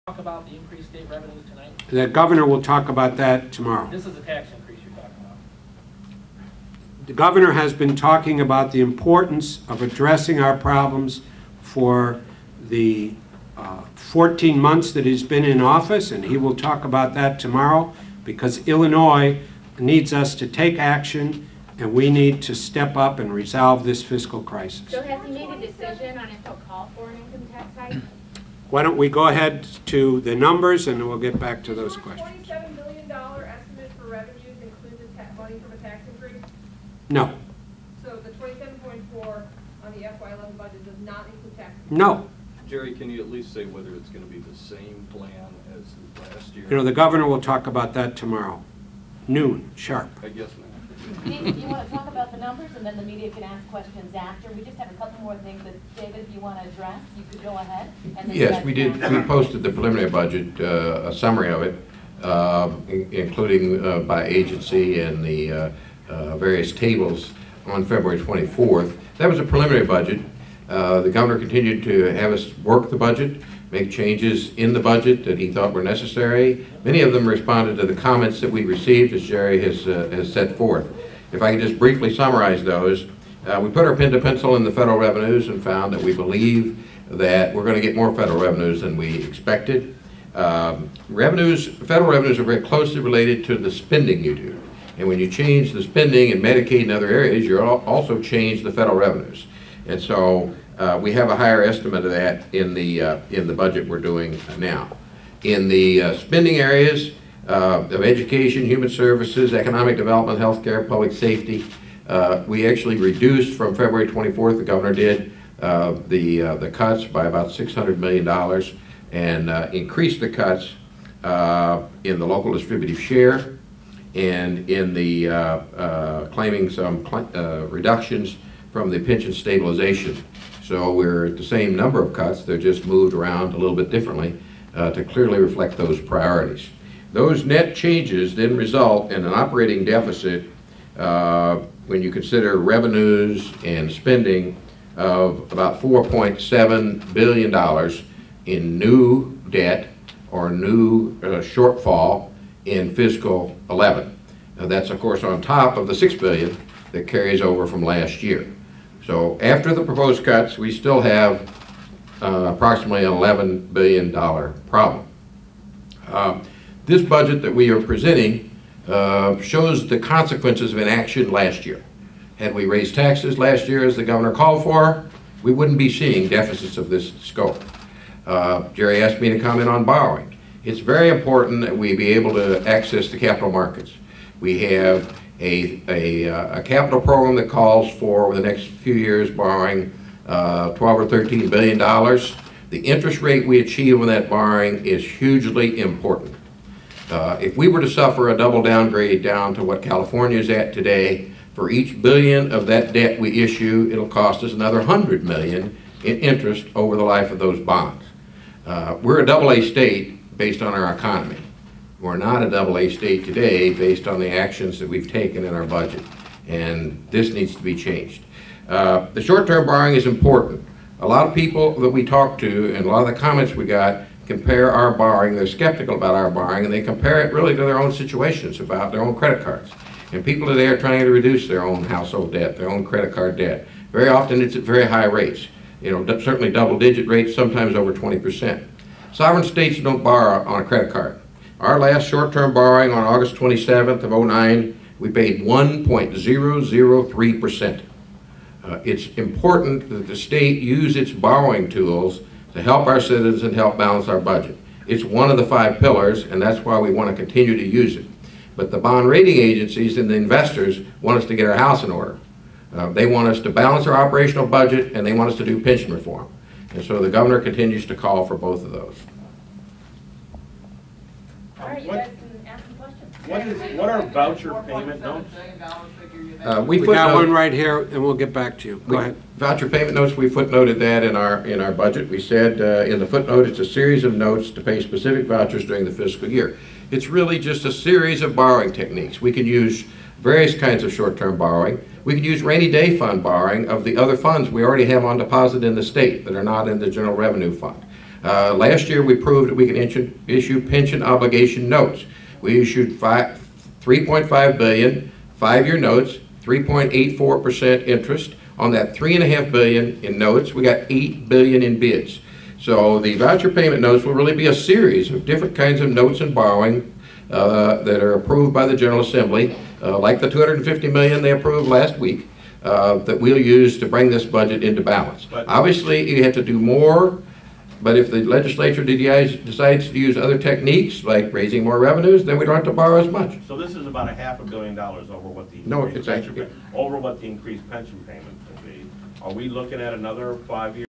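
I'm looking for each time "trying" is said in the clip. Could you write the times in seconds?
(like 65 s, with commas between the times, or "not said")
230 s.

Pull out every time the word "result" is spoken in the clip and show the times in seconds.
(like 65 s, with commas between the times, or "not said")
138 s.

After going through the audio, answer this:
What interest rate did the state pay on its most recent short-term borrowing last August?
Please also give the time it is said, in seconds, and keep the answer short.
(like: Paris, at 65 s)
1.003%, at 245 s.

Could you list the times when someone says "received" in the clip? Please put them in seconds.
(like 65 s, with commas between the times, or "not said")
78 s.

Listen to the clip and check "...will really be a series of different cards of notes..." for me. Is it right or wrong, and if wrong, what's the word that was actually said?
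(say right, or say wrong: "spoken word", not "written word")
wrong: "kinds", not "cards".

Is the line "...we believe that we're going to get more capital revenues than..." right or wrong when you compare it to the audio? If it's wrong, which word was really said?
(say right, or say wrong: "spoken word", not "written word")
wrong: "federal", not "capital".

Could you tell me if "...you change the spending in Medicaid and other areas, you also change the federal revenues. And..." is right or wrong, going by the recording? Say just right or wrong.
right.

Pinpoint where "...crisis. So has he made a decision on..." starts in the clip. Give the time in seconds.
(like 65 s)
24 s.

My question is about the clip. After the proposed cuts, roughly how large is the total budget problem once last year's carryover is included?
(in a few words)
$11 billion.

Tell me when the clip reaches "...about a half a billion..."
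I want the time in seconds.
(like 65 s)
333 s.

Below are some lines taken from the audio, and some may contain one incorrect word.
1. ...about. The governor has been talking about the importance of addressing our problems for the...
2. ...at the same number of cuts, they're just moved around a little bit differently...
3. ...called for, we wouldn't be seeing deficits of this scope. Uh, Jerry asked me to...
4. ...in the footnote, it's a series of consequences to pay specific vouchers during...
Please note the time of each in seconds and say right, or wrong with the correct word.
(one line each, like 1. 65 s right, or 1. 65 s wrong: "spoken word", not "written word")
1. 5 s right
2. 131 s right
3. 174 s right
4. 282 s wrong: "notes", not "consequences".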